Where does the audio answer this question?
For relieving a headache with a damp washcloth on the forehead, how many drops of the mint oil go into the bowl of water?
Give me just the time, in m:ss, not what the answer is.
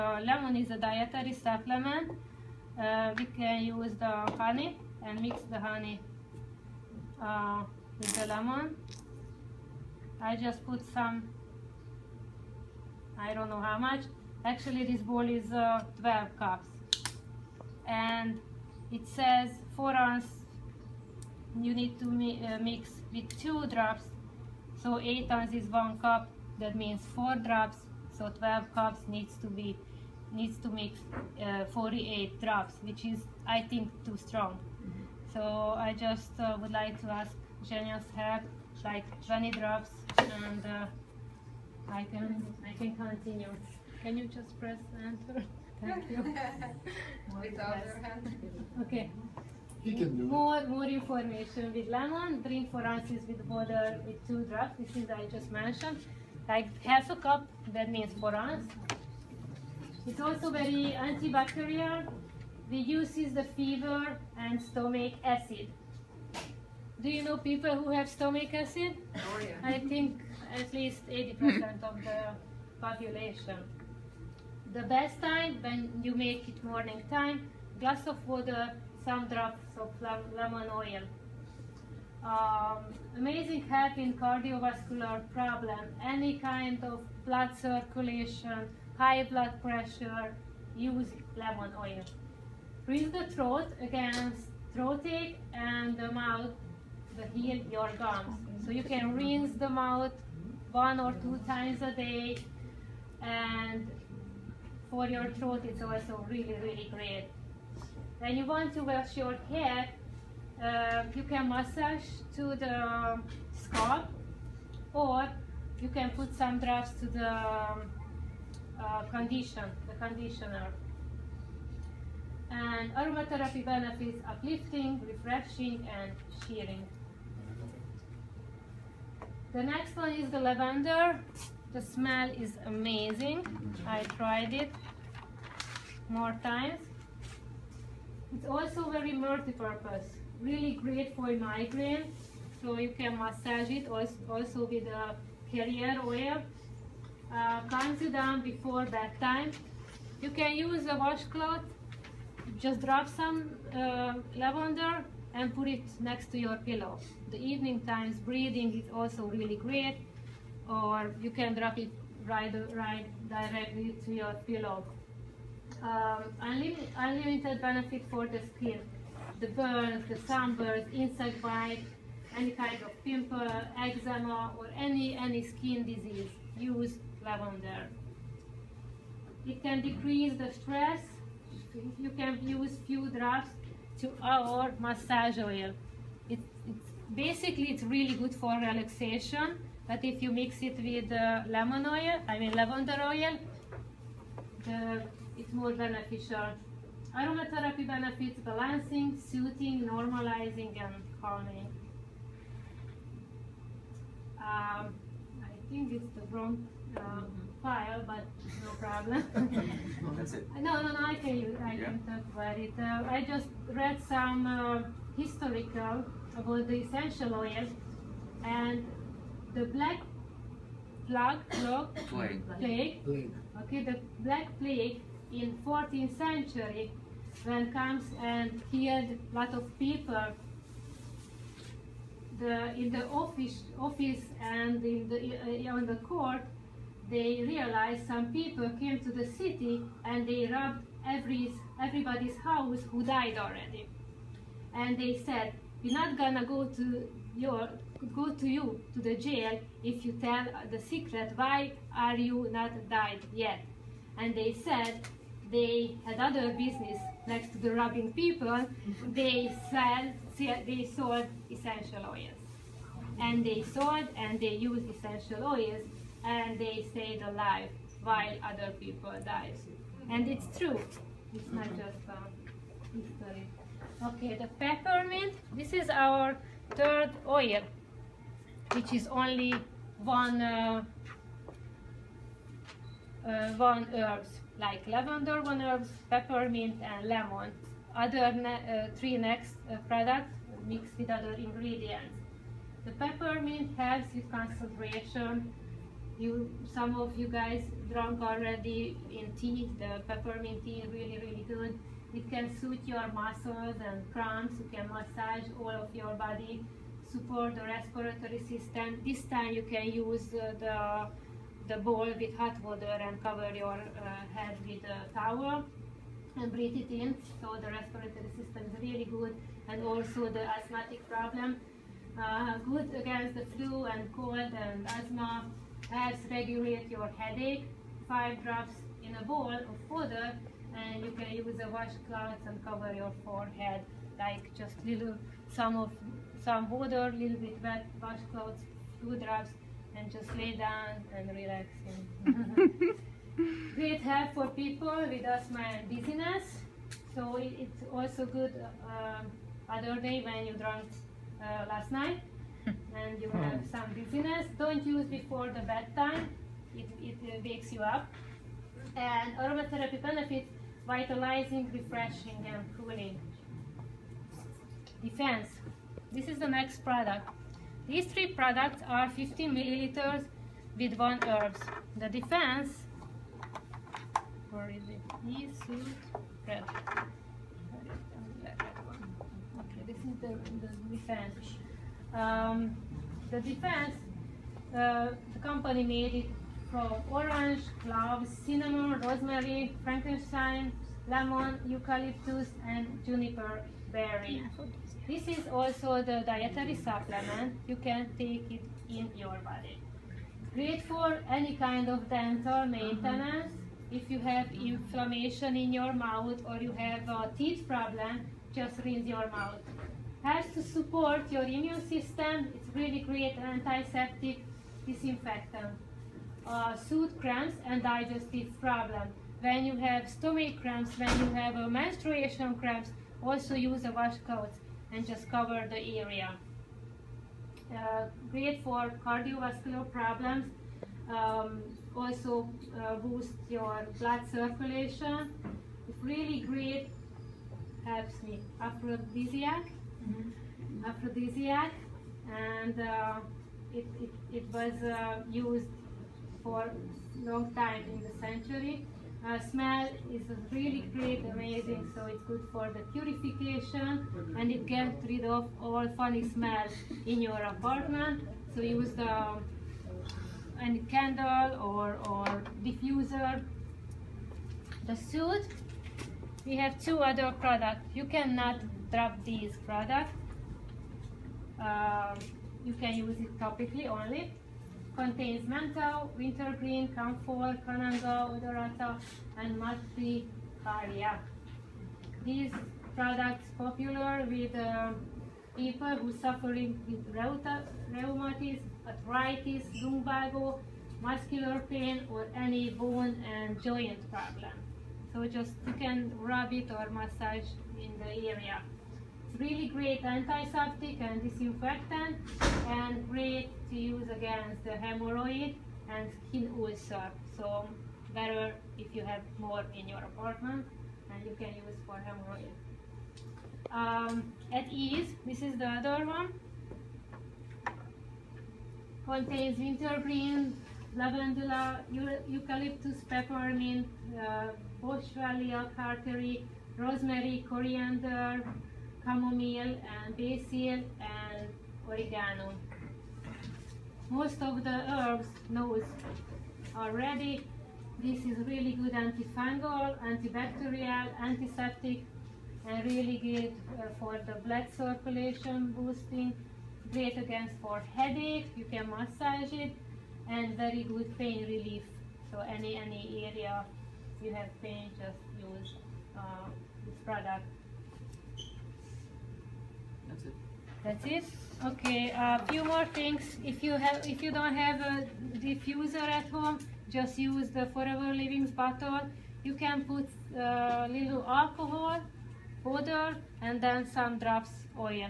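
5:28.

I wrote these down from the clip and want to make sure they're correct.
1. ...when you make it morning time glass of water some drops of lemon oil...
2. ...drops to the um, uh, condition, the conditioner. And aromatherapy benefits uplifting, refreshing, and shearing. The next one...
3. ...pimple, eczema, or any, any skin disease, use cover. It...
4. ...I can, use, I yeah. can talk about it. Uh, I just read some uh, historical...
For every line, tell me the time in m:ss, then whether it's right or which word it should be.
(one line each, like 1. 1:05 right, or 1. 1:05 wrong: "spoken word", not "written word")
1. 1:15 right
2. 1:56 right
3. 2:53 wrong: "lavender", not "cover"
4. 3:31 right.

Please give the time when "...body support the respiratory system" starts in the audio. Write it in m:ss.
5:06.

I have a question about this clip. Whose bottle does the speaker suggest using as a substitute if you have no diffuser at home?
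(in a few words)
Forever Living.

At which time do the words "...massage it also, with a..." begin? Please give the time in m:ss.
2:23.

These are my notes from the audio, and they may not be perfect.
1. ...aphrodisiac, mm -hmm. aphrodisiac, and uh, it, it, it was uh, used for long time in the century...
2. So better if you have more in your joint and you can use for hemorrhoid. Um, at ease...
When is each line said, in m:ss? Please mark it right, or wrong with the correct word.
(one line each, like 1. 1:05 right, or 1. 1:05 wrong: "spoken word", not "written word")
1. 7:18 right
2. 8:27 wrong: "apartment", not "joint".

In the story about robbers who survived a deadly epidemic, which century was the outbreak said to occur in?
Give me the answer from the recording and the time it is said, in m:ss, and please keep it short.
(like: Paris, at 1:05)
14th century, at 3:45.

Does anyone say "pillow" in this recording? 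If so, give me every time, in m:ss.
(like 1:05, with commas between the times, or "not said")
2:36, 2:44.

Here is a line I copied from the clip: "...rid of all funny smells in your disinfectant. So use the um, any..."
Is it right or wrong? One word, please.
wrong.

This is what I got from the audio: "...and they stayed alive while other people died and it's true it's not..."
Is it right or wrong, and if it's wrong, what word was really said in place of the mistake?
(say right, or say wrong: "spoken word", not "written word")
right.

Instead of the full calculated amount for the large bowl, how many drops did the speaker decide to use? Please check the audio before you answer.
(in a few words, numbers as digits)
20.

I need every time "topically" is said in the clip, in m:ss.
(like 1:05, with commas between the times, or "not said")
7:53.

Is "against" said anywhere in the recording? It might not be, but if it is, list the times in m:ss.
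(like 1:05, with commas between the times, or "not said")
1:33, 5:23, 8:24, 9:07.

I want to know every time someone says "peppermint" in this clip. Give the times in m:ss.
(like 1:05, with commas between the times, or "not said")
4:34, 4:46, 4:52, 5:00, 8:43.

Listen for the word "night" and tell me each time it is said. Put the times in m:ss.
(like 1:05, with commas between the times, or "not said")
5:51.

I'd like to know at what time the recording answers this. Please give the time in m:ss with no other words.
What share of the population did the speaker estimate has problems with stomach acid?
1:11.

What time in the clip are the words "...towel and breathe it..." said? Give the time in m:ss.
5:15.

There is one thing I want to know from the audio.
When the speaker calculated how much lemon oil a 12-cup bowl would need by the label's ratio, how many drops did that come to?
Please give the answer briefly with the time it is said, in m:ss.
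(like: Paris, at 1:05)
48, at 0:31.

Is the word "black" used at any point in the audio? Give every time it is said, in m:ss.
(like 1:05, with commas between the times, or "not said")
3:39, 3:44.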